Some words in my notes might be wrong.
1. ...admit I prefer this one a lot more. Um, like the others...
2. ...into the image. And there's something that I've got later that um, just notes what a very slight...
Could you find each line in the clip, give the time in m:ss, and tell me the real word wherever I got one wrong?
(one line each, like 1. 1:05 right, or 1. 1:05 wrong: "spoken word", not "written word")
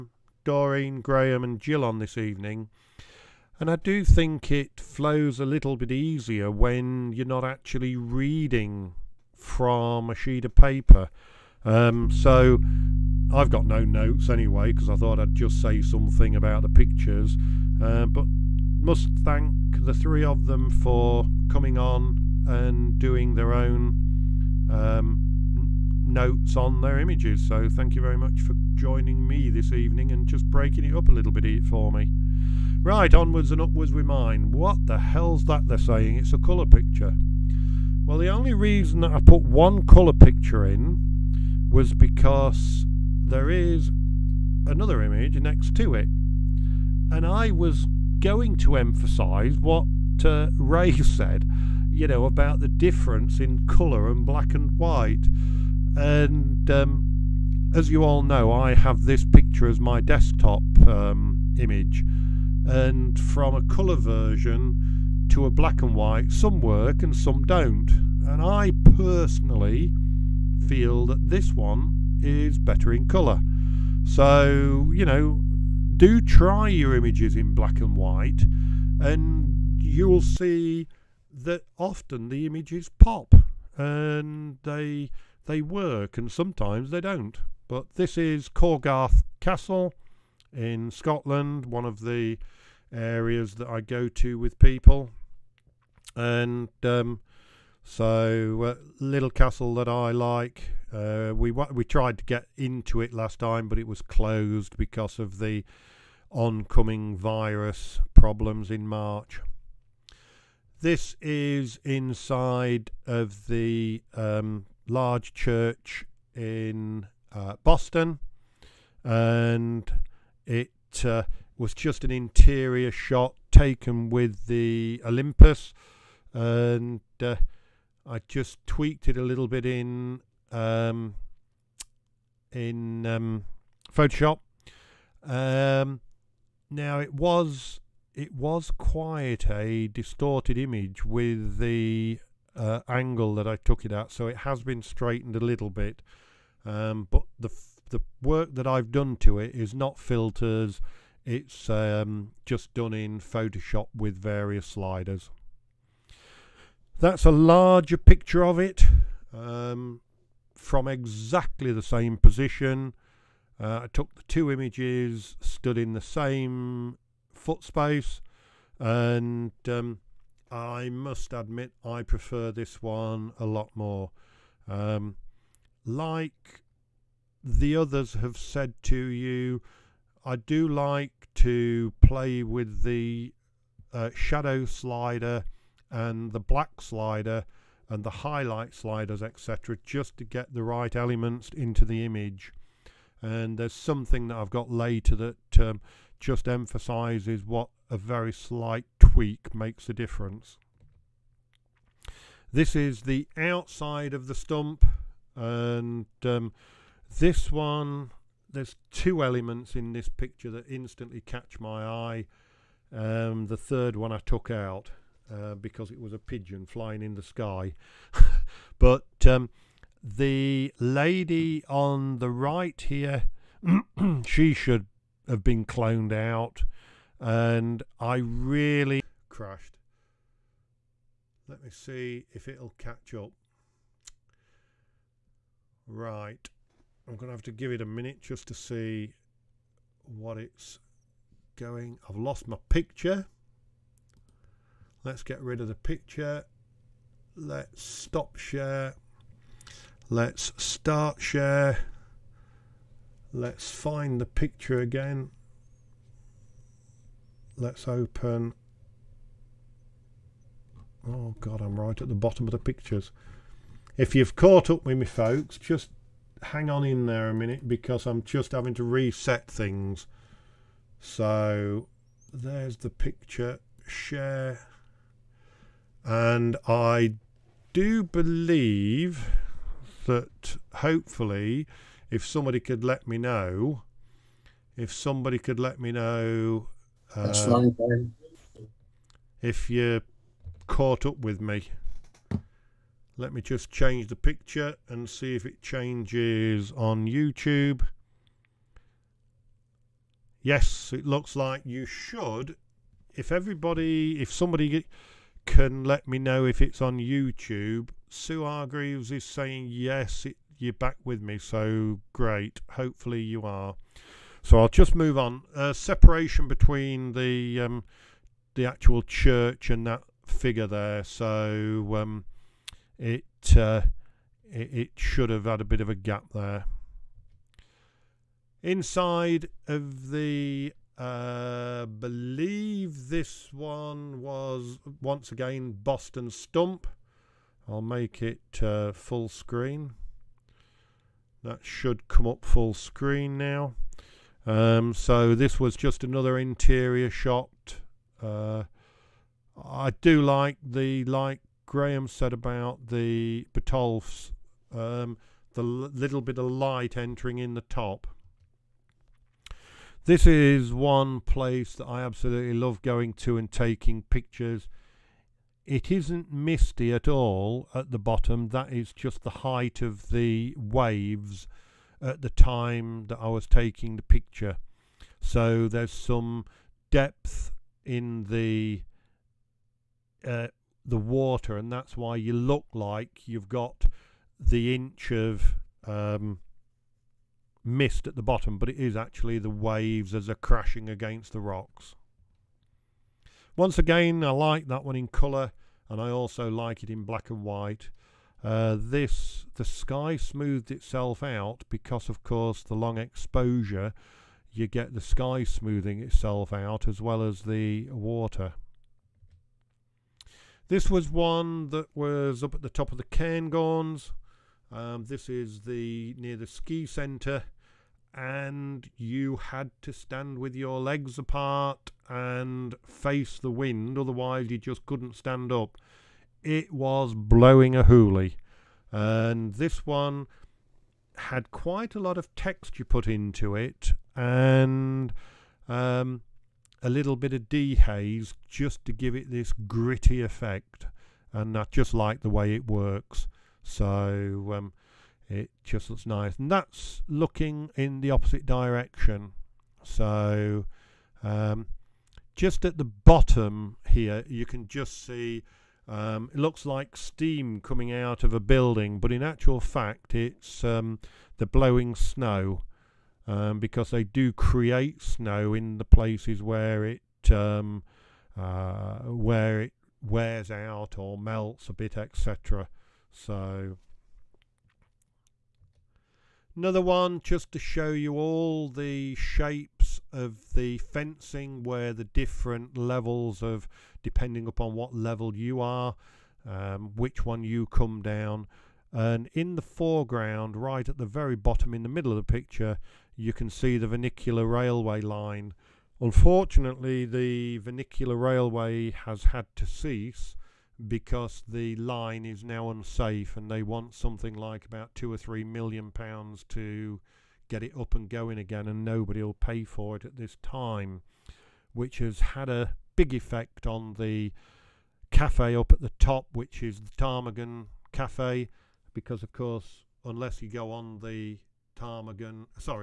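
1. 2:51 right
2. 3:11 wrong: "emphasizes", not "notes".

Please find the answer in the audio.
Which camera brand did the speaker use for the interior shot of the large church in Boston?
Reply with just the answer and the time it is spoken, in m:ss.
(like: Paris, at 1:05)
Olympus, at 2:05.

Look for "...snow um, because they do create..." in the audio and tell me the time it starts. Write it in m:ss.
7:41.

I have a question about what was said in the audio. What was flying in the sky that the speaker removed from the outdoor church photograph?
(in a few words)
A pigeon.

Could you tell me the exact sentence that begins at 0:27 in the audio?
So thank you very much for joining me this evening and just breaking it up a little bit for me.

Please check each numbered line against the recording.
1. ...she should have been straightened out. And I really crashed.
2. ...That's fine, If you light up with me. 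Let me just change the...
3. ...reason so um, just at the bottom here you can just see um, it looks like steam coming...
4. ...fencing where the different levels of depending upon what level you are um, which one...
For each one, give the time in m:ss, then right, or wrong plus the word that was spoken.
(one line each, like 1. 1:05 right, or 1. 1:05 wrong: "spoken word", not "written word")
1. 3:44 wrong: "cloned", not "straightened"
2. 4:47 wrong: "caught", not "light"
3. 7:28 wrong: "direction", not "reason"
4. 8:00 right.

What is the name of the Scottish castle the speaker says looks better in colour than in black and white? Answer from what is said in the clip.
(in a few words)
Corgarff Castle.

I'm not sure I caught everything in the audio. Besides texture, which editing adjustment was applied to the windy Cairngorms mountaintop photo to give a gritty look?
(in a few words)
Dehaze.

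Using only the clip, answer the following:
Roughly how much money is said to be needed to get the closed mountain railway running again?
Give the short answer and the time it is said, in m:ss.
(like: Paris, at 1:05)
2 or 3 million pounds, at 8:24.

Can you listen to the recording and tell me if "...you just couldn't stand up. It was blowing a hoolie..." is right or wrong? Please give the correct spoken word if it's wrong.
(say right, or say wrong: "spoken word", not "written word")
right.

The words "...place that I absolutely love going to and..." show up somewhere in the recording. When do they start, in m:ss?
6:01.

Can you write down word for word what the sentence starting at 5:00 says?
Yes, it looks like you should.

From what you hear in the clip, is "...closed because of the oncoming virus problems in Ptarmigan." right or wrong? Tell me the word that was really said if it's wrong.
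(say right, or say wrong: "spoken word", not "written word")
wrong: "March", not "Ptarmigan".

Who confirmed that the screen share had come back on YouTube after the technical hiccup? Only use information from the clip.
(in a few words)
Sue Hargreaves.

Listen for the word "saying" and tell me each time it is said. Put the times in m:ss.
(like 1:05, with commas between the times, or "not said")
0:35, 5:09.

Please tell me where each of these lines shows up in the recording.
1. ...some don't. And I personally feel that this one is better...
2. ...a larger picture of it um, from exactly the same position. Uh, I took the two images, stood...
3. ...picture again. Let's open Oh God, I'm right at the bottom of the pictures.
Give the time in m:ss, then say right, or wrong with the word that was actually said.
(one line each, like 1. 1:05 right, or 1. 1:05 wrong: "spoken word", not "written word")
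1. 1:07 right
2. 2:37 right
3. 4:14 right.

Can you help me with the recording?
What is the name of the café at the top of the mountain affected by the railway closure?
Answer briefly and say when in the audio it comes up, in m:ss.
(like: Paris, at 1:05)
Ptarmigan cafe, at 8:36.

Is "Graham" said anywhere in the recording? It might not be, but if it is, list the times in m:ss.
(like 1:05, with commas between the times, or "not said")
0:01, 5:51.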